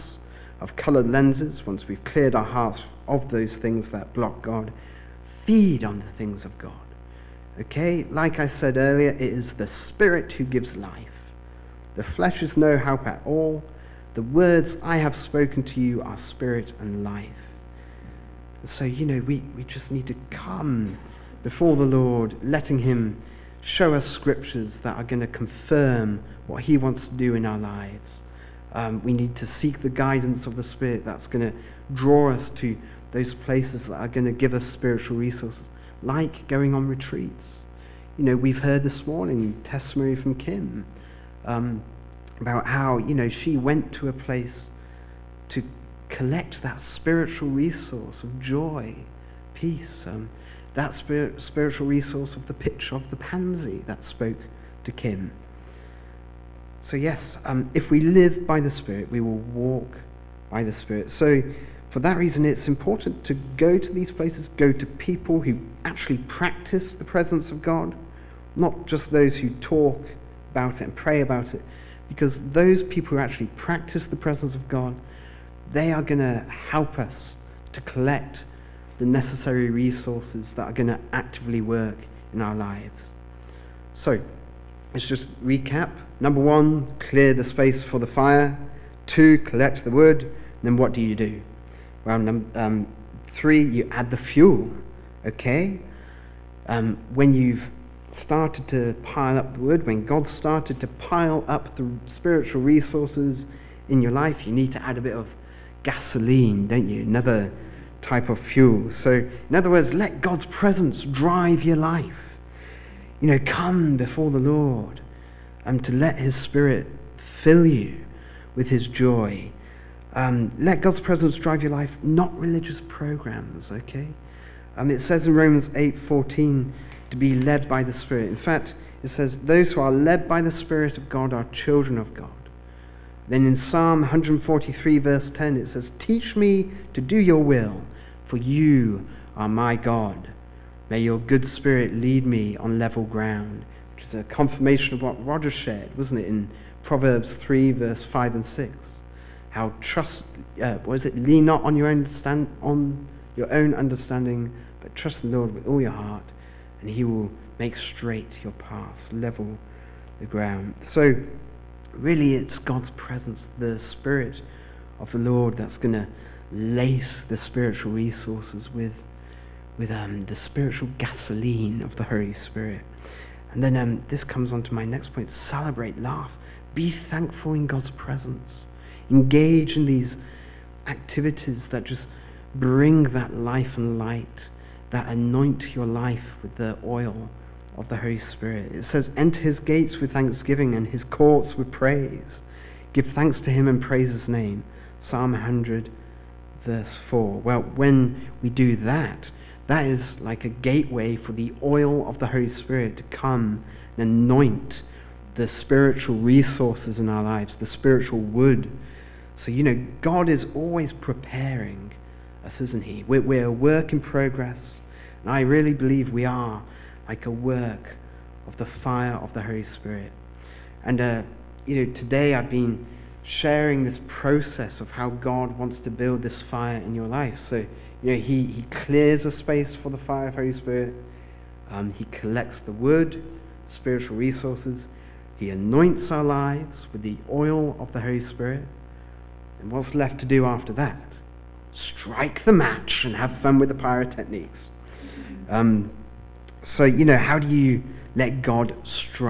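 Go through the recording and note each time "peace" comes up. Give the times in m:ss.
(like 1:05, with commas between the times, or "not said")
0:49.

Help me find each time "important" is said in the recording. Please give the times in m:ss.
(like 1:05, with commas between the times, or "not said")
1:02.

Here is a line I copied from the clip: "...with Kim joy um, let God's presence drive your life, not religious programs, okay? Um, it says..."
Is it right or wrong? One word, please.
wrong.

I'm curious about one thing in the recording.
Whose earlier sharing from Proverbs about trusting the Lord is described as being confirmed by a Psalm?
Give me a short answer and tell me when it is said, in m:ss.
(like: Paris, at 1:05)
Roger, at 2:25.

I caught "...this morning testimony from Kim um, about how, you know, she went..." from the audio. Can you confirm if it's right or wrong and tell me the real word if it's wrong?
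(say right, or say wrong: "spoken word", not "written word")
right.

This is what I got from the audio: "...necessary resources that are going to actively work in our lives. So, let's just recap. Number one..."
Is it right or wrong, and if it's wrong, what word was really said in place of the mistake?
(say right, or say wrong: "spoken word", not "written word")
right.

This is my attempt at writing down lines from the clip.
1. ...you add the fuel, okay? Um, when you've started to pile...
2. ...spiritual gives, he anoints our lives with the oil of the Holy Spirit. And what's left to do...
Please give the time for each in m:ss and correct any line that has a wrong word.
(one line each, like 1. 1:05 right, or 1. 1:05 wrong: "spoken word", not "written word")
1. 1:33 right
2. 3:53 wrong: "resources", not "gives".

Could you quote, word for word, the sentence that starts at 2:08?
In fact, it says, Those who are led by the Spirit of God are children of God.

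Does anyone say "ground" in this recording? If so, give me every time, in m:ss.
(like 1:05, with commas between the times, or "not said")
2:23, 2:40.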